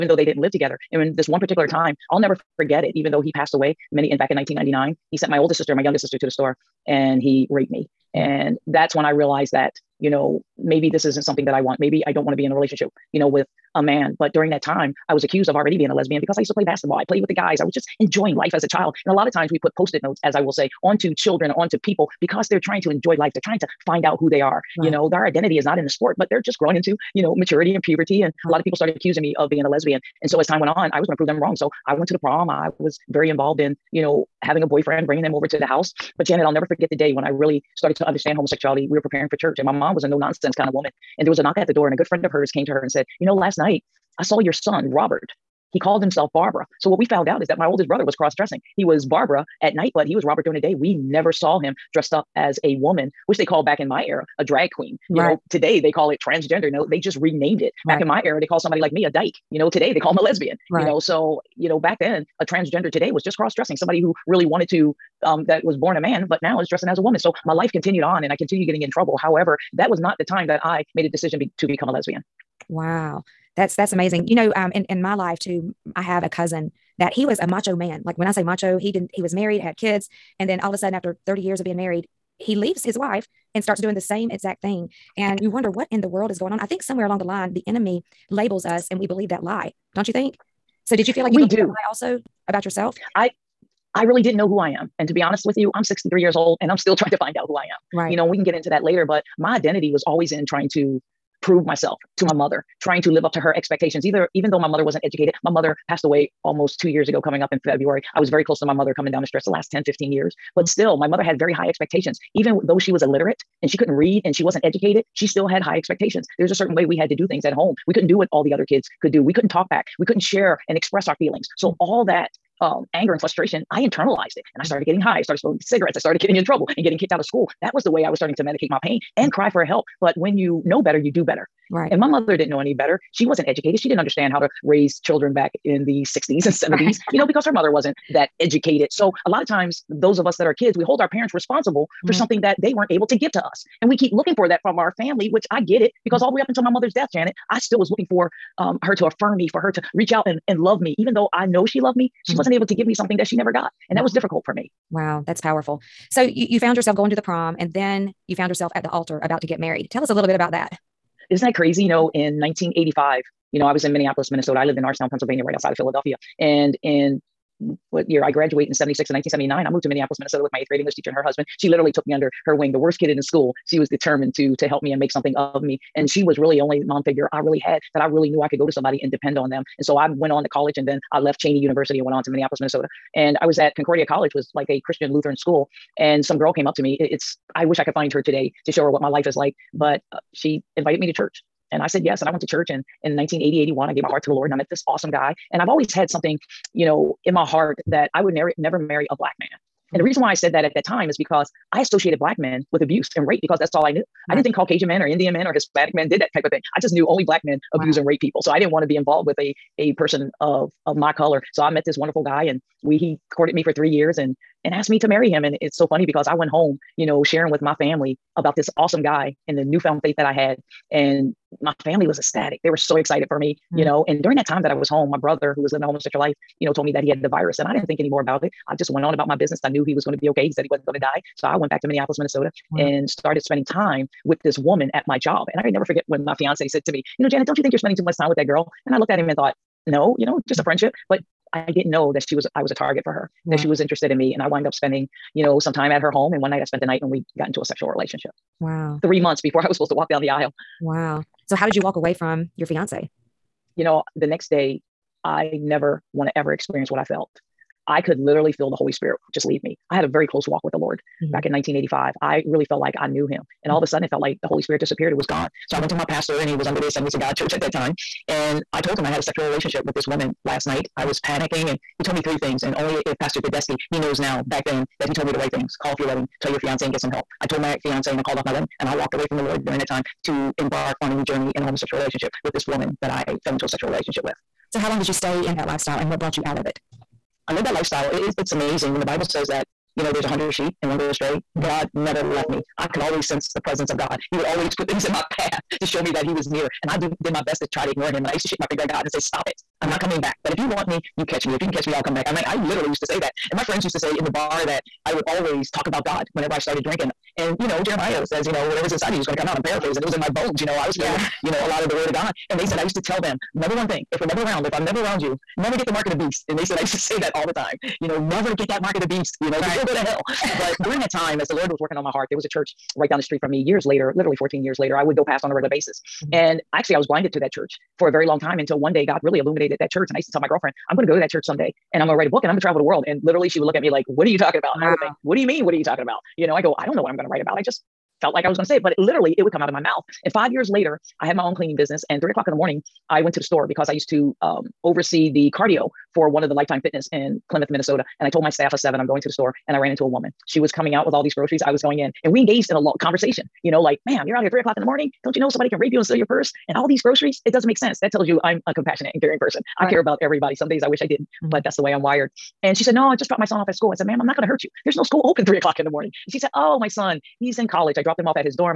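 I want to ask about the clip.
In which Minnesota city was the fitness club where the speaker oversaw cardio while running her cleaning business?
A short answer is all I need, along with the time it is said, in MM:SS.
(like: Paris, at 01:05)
Plymouth, at 05:47.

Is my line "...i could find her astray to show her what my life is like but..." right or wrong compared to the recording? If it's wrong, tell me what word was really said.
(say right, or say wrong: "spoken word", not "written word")
wrong: "today", not "astray".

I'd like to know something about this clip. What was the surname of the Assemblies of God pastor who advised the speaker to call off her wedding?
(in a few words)
Tedeschi.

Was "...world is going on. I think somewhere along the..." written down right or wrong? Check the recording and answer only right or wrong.
right.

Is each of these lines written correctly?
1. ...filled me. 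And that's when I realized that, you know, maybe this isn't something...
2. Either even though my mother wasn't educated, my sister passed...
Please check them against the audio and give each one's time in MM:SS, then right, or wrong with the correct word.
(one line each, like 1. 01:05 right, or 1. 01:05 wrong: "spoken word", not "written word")
1. 00:07 wrong: "raped", not "filled"
2. 01:44 wrong: "mother", not "sister".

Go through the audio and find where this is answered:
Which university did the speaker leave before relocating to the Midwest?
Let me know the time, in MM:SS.
03:01.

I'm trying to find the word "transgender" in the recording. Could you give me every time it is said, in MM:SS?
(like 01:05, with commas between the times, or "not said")
00:56, 01:02.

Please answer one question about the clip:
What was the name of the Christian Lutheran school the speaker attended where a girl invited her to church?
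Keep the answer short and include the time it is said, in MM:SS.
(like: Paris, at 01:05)
Concordia College, at 03:03.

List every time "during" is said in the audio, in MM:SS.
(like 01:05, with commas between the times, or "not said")
00:14, 00:50, 03:44, 04:39, 05:20.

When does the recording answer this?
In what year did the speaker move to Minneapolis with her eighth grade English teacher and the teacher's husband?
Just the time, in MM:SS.
02:49.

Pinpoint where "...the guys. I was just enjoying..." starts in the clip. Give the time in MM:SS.
00:17.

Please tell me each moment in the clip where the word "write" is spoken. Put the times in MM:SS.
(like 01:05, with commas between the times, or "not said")
05:32, 05:37.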